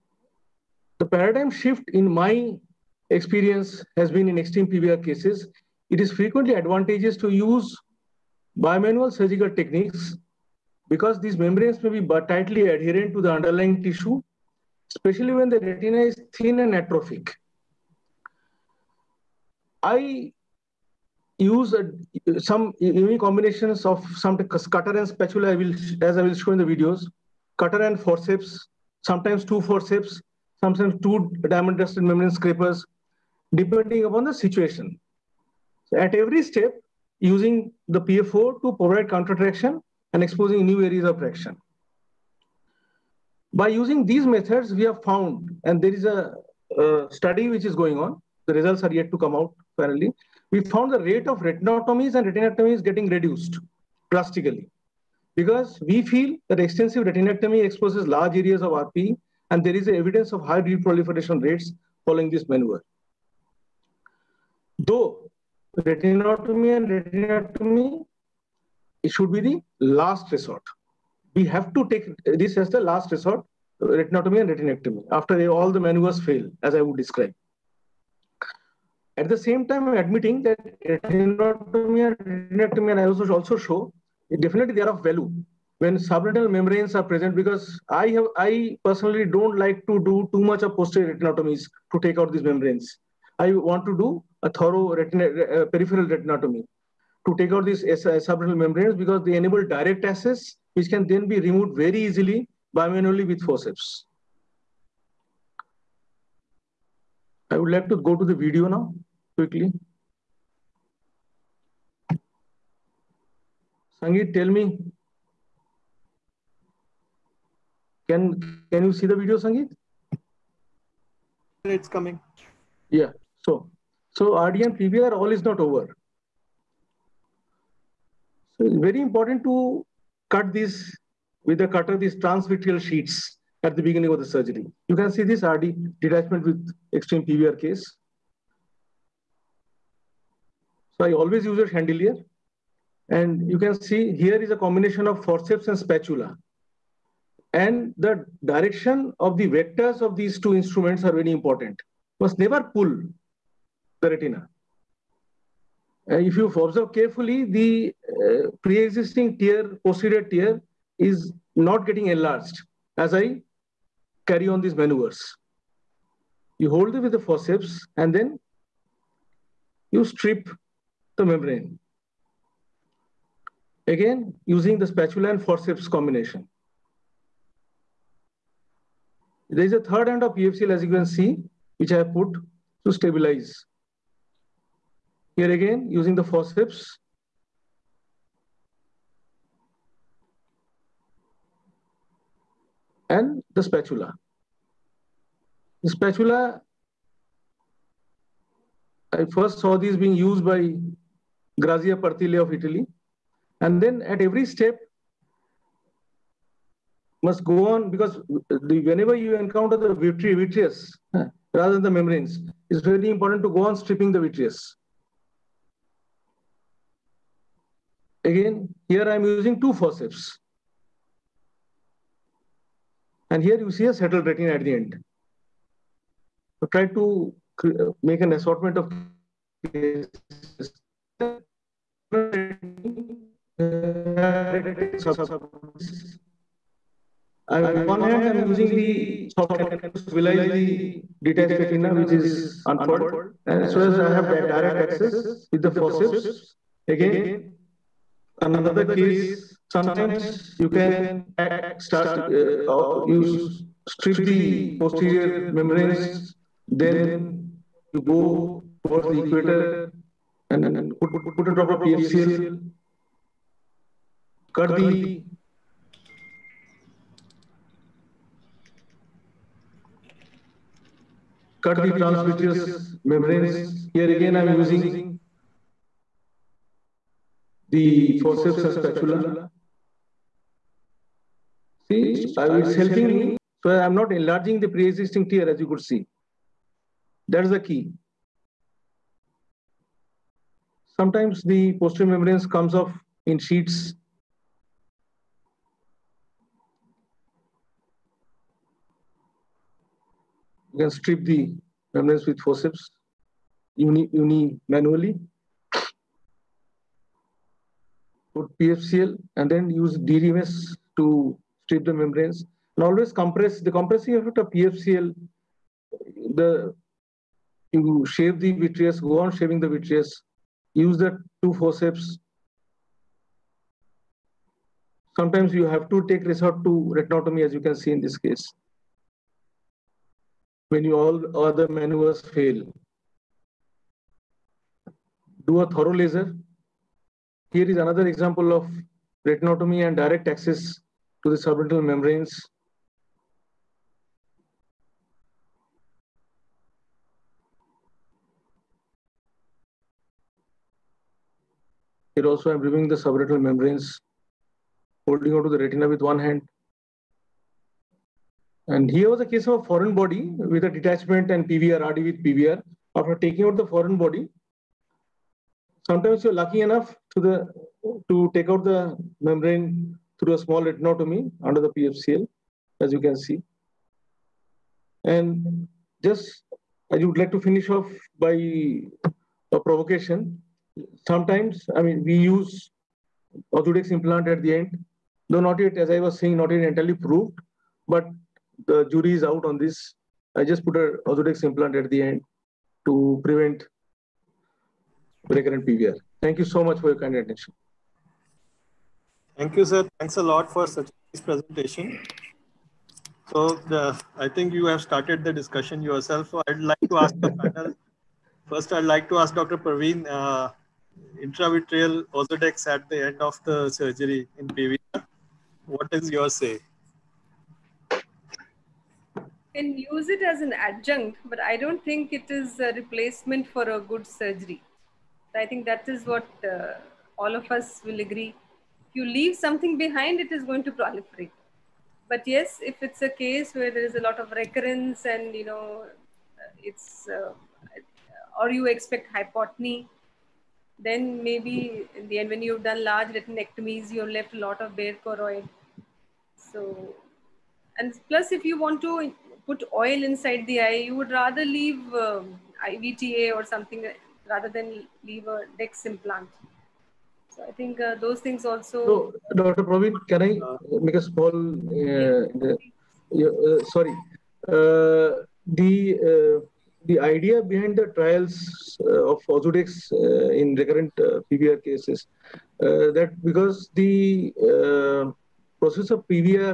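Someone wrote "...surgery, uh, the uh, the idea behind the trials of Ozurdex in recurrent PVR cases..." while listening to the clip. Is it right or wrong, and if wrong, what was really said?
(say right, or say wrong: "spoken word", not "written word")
wrong: "sorry", not "surgery".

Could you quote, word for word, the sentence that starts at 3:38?
Again, here I'm using two forceps.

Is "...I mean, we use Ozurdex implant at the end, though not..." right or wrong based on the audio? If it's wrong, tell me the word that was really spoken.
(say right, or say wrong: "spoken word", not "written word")
right.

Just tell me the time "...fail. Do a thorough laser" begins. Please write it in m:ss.
5:32.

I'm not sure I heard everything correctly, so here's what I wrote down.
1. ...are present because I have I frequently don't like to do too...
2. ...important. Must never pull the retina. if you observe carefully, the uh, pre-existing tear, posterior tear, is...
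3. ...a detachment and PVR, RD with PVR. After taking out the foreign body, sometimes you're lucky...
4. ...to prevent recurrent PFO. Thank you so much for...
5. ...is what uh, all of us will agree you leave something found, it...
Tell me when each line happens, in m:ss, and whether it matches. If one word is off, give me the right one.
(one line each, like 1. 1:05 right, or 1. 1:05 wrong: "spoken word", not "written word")
1. 1:26 wrong: "personally", not "frequently"
2. 2:31 right
3. 6:00 right
4. 6:32 wrong: "PVR", not "PFO"
5. 7:05 wrong: "behind", not "found".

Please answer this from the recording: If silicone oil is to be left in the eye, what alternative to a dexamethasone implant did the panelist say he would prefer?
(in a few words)
IVTA.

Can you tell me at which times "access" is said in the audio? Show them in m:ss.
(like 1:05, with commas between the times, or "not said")
1:40, 4:04, 5:40.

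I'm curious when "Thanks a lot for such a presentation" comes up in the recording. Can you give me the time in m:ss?
6:39.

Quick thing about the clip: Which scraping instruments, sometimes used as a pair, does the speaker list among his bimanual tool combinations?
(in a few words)
diamond dusted membrane scrapers.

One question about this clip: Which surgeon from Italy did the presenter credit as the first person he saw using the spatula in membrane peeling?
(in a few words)
Grazia Pertile.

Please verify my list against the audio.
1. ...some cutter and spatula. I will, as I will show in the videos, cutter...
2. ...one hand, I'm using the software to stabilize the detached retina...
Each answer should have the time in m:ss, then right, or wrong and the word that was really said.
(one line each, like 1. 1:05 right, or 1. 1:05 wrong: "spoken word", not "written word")
1. 0:24 right
2. 3:57 right.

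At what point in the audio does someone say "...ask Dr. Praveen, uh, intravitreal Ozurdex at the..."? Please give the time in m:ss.
6:49.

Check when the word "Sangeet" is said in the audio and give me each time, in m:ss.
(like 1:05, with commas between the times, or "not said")
1:54, 1:59.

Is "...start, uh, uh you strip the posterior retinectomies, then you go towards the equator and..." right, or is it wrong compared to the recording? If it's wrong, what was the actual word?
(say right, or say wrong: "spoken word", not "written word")
wrong: "membranes", not "retinectomies".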